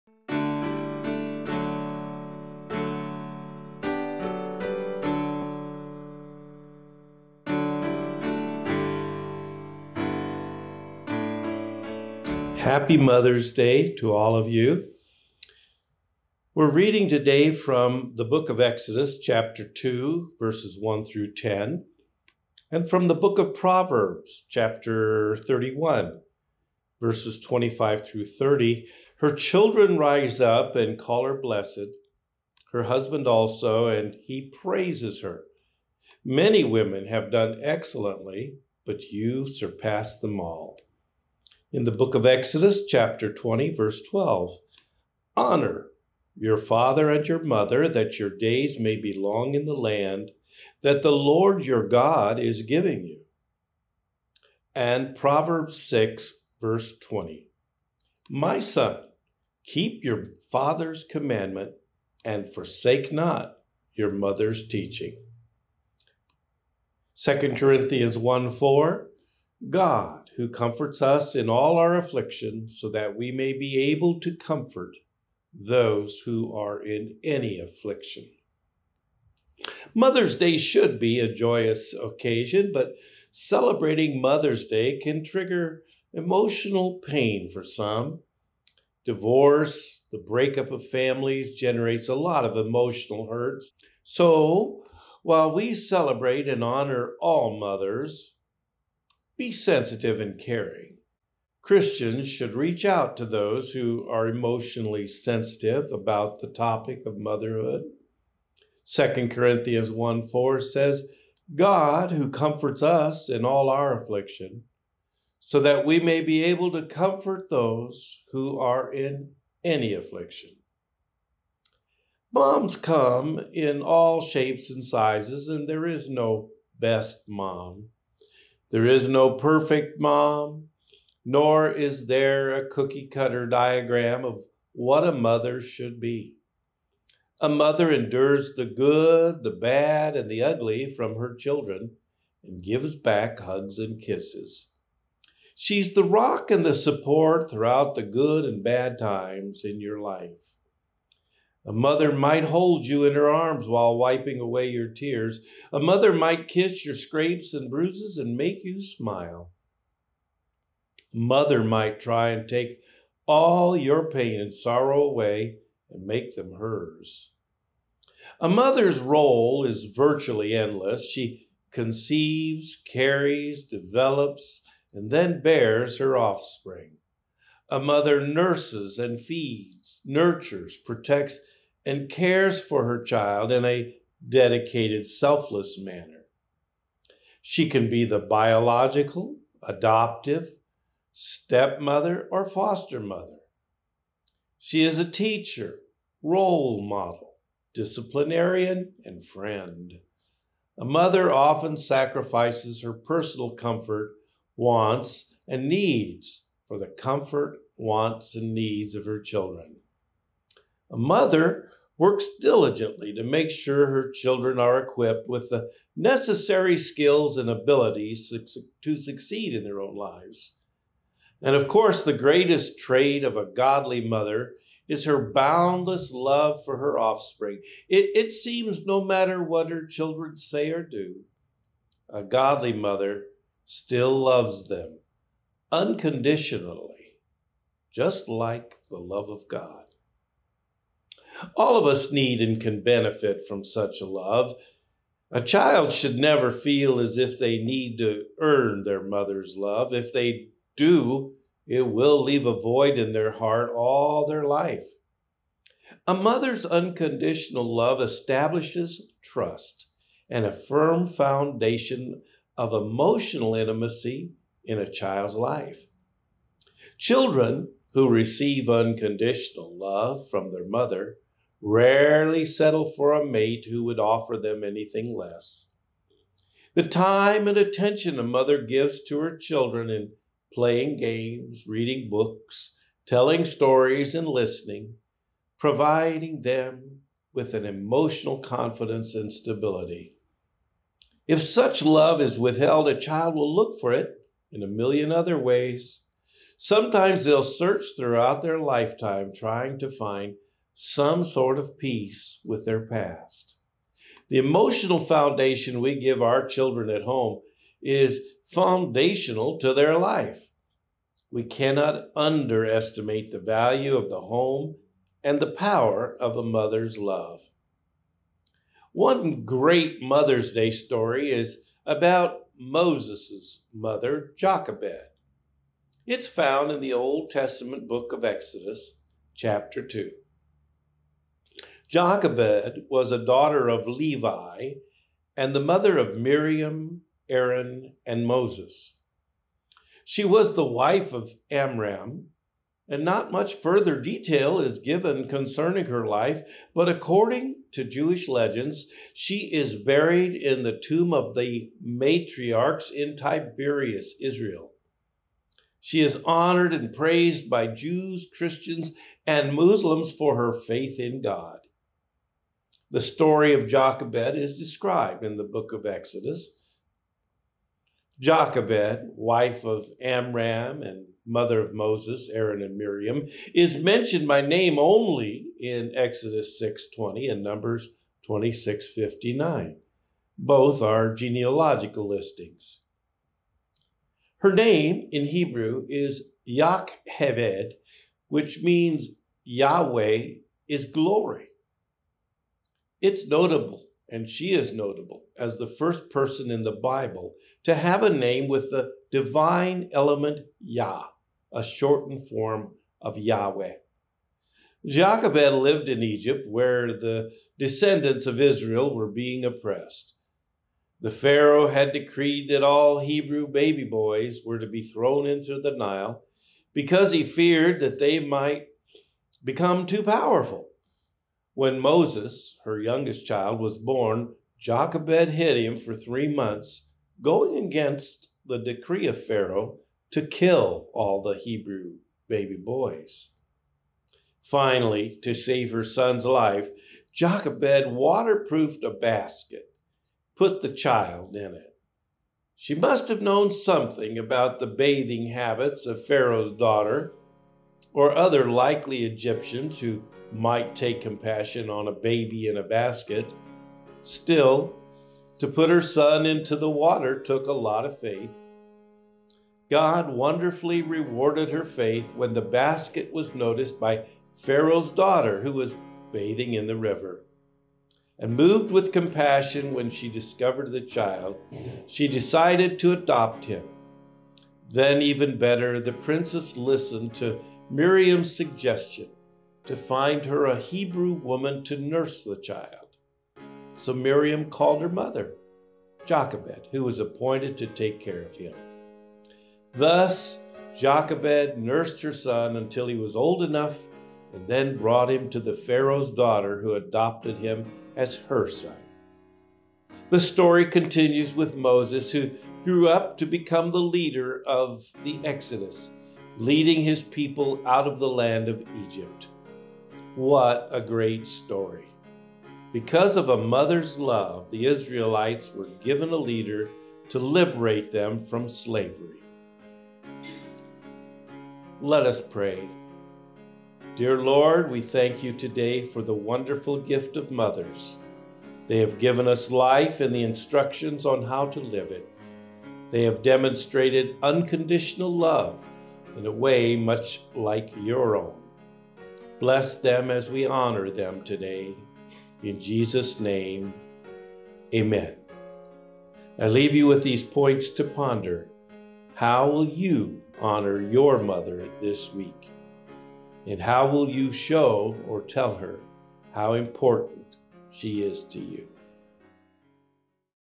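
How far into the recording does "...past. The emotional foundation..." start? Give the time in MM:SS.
05:02.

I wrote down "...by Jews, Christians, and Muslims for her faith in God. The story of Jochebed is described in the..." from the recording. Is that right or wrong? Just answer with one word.
right.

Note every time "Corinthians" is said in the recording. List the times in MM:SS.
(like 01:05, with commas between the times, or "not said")
01:07, 01:49.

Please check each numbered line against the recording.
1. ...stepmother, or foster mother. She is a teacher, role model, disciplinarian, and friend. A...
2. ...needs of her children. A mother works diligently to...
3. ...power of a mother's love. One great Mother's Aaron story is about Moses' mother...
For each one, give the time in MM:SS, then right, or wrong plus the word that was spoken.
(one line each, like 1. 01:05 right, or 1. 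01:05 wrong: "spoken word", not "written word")
1. 03:11 right
2. 03:28 right
3. 05:15 wrong: "Day", not "Aaron".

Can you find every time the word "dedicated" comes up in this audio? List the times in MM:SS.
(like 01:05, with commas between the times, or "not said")
03:04.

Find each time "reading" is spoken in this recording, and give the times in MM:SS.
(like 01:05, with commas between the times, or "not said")
00:16, 04:41.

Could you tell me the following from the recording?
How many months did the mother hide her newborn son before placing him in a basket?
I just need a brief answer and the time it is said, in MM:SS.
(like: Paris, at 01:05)
3, at 07:05.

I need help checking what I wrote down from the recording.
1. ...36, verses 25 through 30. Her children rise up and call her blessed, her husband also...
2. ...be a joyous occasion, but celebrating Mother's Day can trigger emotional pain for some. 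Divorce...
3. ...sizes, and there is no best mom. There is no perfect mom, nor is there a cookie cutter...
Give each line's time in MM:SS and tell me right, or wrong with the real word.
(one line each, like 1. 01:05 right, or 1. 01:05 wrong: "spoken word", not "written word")
1. 00:25 wrong: "31", not "36"
2. 01:20 right
3. 02:04 right.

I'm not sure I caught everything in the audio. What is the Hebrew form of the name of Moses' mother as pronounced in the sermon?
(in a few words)
Yacheved.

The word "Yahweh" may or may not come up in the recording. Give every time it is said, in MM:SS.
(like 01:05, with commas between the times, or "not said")
06:29, 06:43.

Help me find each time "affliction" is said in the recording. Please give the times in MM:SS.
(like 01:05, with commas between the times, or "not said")
01:11, 01:17, 01:53, 01:59.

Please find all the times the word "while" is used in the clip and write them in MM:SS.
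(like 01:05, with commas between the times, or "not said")
01:35, 02:33.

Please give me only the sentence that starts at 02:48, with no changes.
A mother's role is virtually endless.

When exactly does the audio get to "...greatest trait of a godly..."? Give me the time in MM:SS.
03:42.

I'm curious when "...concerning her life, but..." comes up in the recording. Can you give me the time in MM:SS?
05:45.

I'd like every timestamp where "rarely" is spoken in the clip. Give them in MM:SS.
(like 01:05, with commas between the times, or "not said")
04:31.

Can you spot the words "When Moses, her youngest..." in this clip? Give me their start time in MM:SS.
07:01.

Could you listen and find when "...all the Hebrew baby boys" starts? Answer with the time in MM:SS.
07:10.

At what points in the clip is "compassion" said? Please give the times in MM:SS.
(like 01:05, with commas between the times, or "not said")
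07:30, 07:48.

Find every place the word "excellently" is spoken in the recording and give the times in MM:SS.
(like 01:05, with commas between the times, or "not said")
00:37.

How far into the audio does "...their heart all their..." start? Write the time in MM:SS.
04:13.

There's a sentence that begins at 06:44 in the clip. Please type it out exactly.
Jochebed lived in Egypt, where the descendants of Israel were being oppressed.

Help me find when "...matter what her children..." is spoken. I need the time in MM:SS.
03:49.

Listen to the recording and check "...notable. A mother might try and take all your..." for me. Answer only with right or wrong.
wrong.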